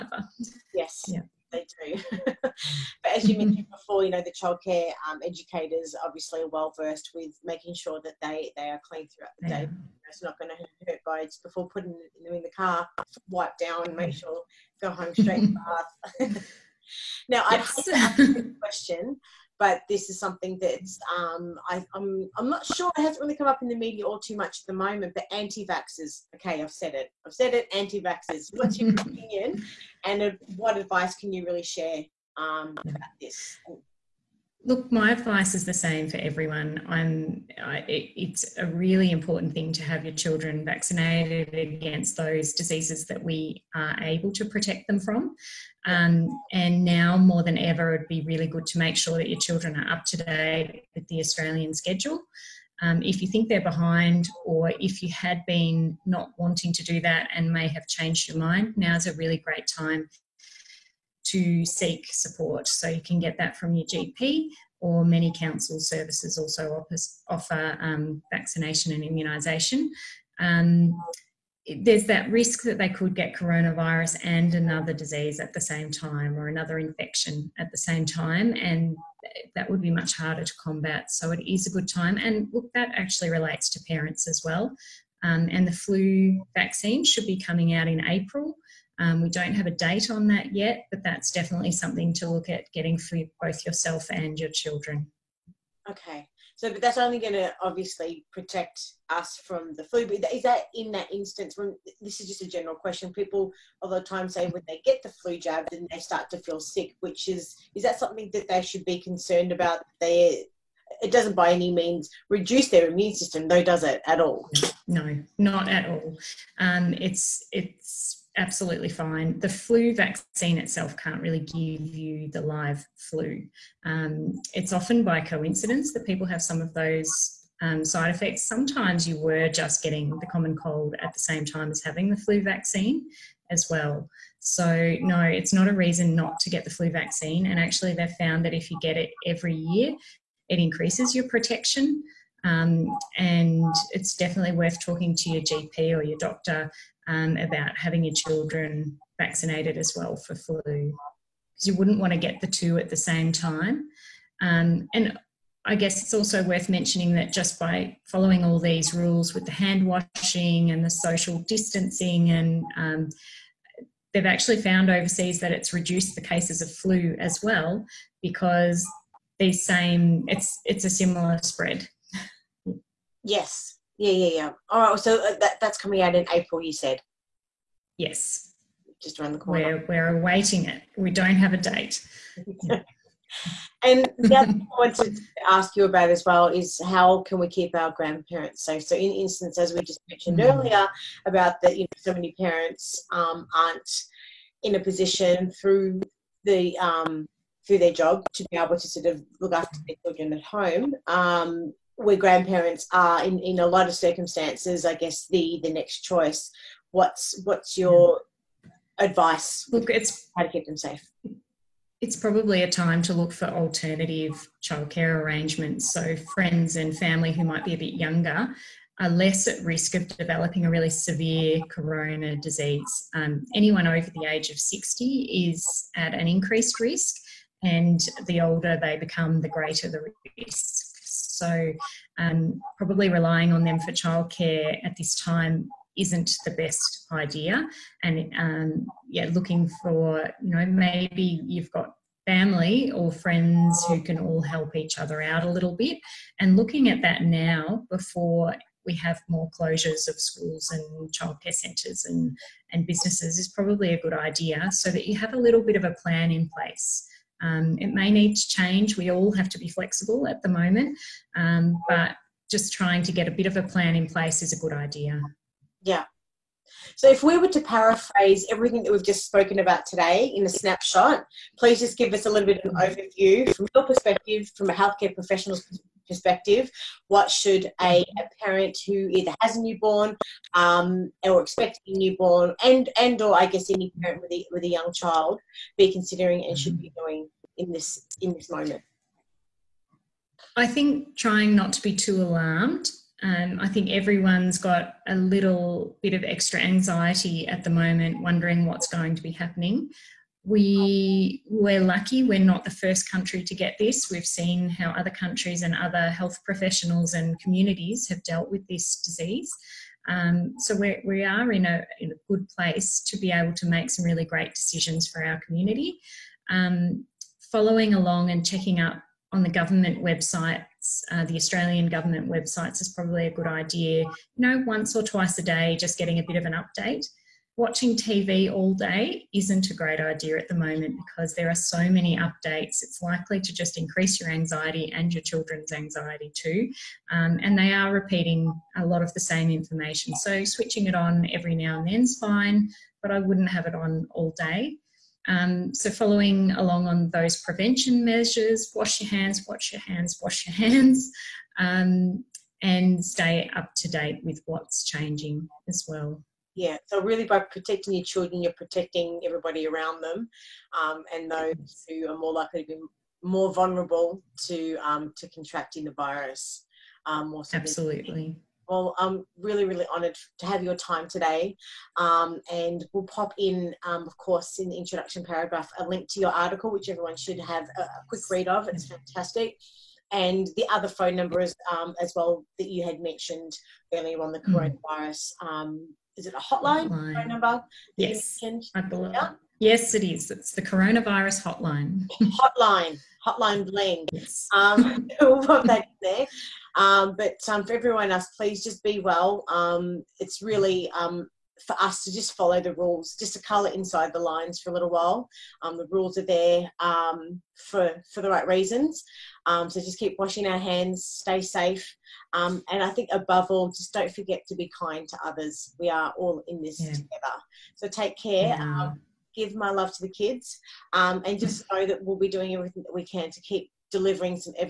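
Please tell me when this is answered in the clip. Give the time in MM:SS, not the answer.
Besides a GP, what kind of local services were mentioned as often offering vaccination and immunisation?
01:05.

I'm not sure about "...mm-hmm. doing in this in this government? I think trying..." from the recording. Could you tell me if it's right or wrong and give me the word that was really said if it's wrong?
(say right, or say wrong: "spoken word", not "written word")
wrong: "moment", not "government".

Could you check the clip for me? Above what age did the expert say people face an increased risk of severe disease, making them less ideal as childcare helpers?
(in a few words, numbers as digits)
60.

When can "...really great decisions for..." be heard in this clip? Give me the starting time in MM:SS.
05:14.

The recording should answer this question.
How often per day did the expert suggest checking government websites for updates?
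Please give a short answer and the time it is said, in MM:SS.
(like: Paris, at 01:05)
once or twice, at 05:24.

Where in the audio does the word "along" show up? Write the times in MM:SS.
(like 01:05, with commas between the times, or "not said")
05:17, 05:46.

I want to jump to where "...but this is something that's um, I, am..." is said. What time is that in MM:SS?
00:19.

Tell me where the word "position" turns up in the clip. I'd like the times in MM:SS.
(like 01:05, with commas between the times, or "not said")
03:14.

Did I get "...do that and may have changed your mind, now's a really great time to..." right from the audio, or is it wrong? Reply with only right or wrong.
right.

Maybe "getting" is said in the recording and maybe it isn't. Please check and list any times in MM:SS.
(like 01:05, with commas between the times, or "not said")
01:32, 02:09, 05:25.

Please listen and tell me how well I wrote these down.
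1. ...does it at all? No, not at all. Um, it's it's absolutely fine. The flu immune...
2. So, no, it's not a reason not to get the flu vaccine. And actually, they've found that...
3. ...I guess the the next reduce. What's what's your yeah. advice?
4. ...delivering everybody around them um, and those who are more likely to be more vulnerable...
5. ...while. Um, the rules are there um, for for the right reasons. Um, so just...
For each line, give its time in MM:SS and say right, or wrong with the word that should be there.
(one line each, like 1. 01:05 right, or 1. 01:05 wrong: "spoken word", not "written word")
1. 01:53 wrong: "vaccine", not "immune"
2. 02:14 right
3. 03:24 wrong: "choice", not "reduce"
4. 05:58 wrong: "protecting", not "delivering"
5. 06:44 right.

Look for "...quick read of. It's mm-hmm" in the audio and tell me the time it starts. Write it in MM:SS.
06:18.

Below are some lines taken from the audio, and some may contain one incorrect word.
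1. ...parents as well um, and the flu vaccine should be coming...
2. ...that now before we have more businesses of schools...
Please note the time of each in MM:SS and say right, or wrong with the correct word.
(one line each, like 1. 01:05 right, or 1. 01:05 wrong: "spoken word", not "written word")
1. 01:23 right
2. 04:07 wrong: "closures", not "businesses".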